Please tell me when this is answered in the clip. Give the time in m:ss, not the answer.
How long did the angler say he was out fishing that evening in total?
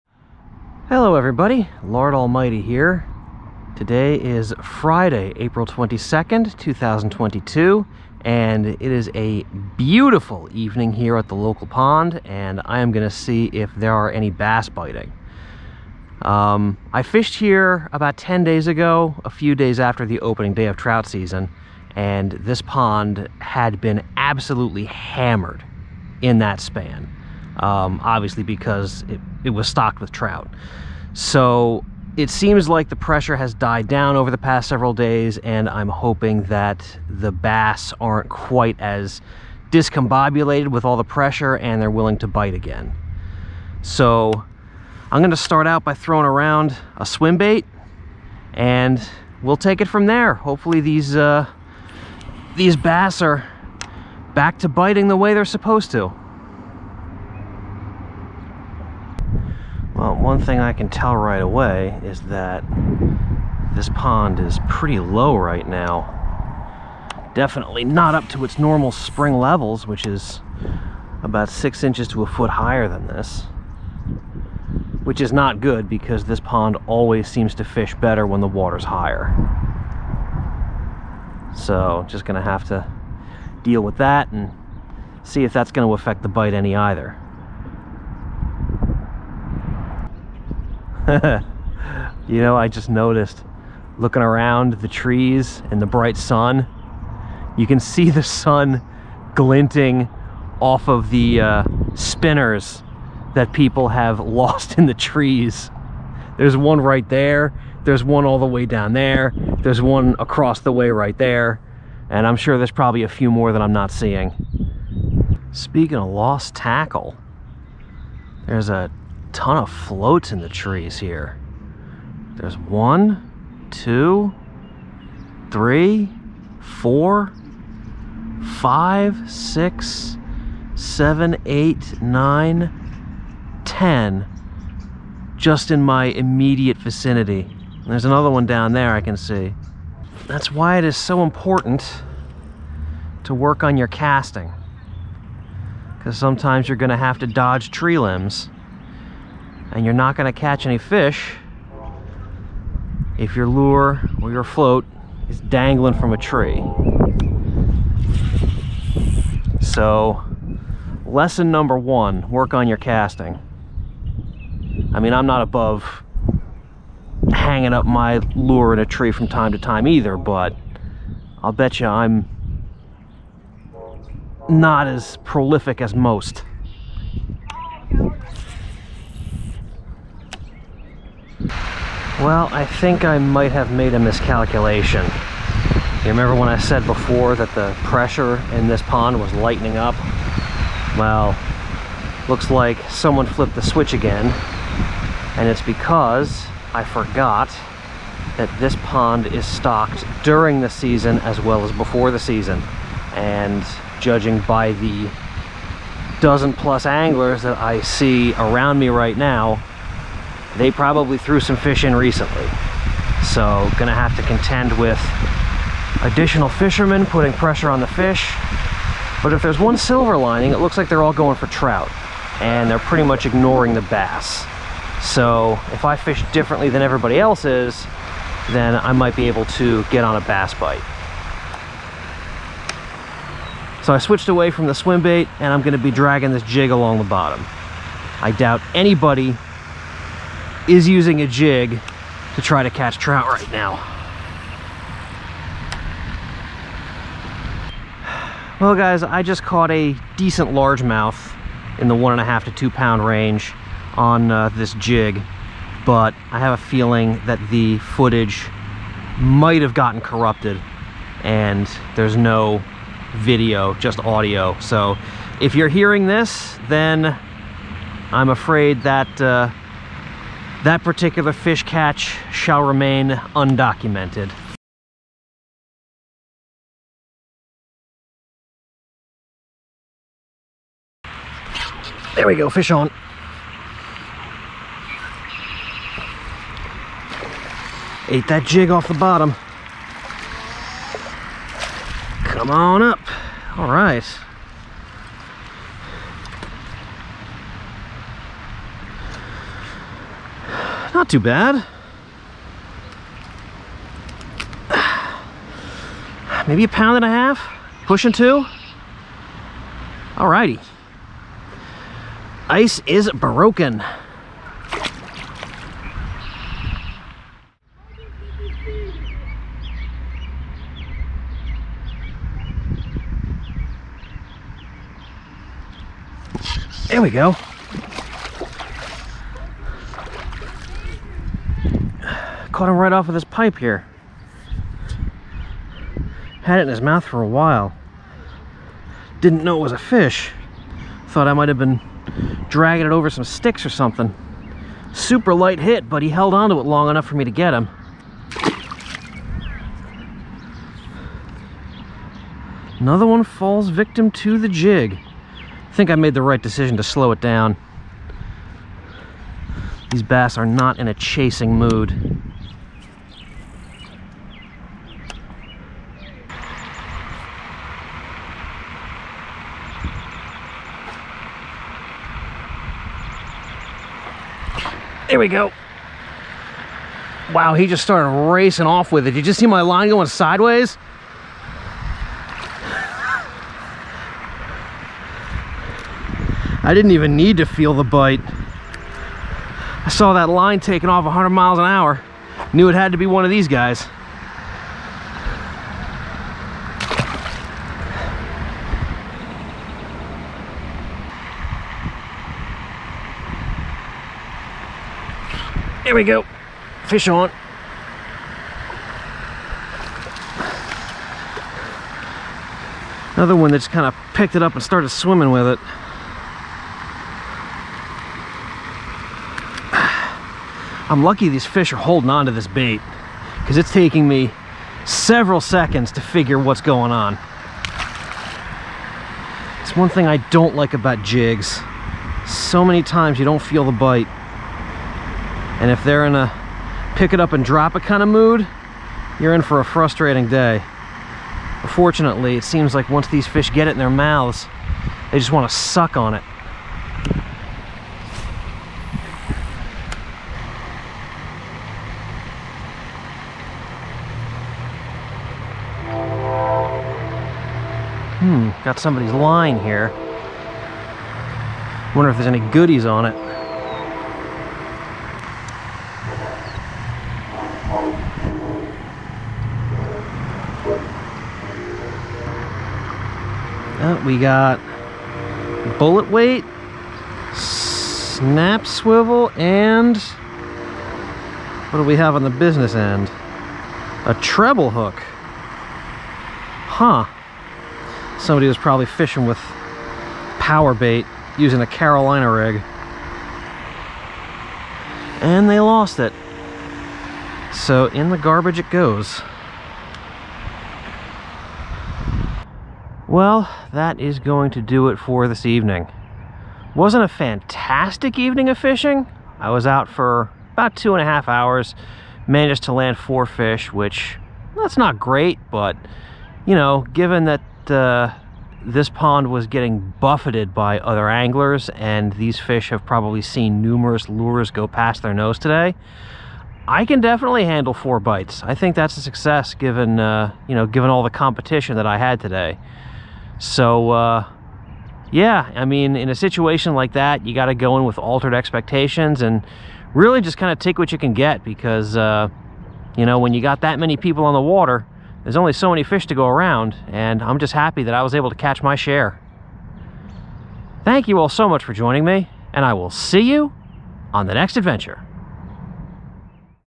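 8:30.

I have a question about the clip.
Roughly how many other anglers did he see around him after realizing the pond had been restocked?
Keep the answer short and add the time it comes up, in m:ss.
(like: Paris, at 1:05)
dozen plus, at 3:26.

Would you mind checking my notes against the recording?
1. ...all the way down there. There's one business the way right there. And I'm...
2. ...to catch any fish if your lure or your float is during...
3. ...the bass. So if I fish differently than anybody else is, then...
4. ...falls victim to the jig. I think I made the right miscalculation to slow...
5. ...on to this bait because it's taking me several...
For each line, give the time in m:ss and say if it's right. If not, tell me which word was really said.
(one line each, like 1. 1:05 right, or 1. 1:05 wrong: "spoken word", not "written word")
1. 1:48 wrong: "across", not "business"
2. 2:30 wrong: "dangling", not "during"
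3. 3:43 wrong: "everybody", not "anybody"
4. 5:53 wrong: "decision", not "miscalculation"
5. 7:02 right.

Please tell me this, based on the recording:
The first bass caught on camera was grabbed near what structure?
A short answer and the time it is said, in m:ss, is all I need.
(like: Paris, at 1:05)
pipe, at 5:33.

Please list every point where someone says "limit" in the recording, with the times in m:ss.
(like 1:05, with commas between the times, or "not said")
not said.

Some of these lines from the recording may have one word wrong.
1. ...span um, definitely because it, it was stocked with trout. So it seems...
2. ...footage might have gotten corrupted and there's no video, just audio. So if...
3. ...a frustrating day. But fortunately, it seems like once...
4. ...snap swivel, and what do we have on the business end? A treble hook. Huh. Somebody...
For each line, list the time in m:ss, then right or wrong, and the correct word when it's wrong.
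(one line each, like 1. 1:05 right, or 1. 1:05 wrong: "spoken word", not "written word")
1. 0:26 wrong: "obviously", not "definitely"
2. 4:17 right
3. 7:19 right
4. 7:57 right.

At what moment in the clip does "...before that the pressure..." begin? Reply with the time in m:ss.
3:06.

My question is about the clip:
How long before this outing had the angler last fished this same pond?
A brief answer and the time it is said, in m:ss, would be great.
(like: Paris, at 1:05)
10 days, at 0:18.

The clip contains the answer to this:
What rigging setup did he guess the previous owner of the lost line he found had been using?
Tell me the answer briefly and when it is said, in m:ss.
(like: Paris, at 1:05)
Carolina rig, at 8:11.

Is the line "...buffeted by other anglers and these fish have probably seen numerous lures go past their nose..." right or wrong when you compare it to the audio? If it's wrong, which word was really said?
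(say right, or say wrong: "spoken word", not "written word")
right.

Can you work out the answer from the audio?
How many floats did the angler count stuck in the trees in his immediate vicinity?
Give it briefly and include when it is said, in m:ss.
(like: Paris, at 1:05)
10, at 2:13.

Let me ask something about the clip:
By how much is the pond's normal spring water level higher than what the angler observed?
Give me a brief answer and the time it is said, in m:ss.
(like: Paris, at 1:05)
six inches to a foot, at 1:11.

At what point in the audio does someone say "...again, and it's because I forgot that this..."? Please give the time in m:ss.
3:13.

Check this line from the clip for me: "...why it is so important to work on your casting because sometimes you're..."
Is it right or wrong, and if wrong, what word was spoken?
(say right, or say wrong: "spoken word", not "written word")
right.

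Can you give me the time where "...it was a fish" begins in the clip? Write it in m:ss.
5:39.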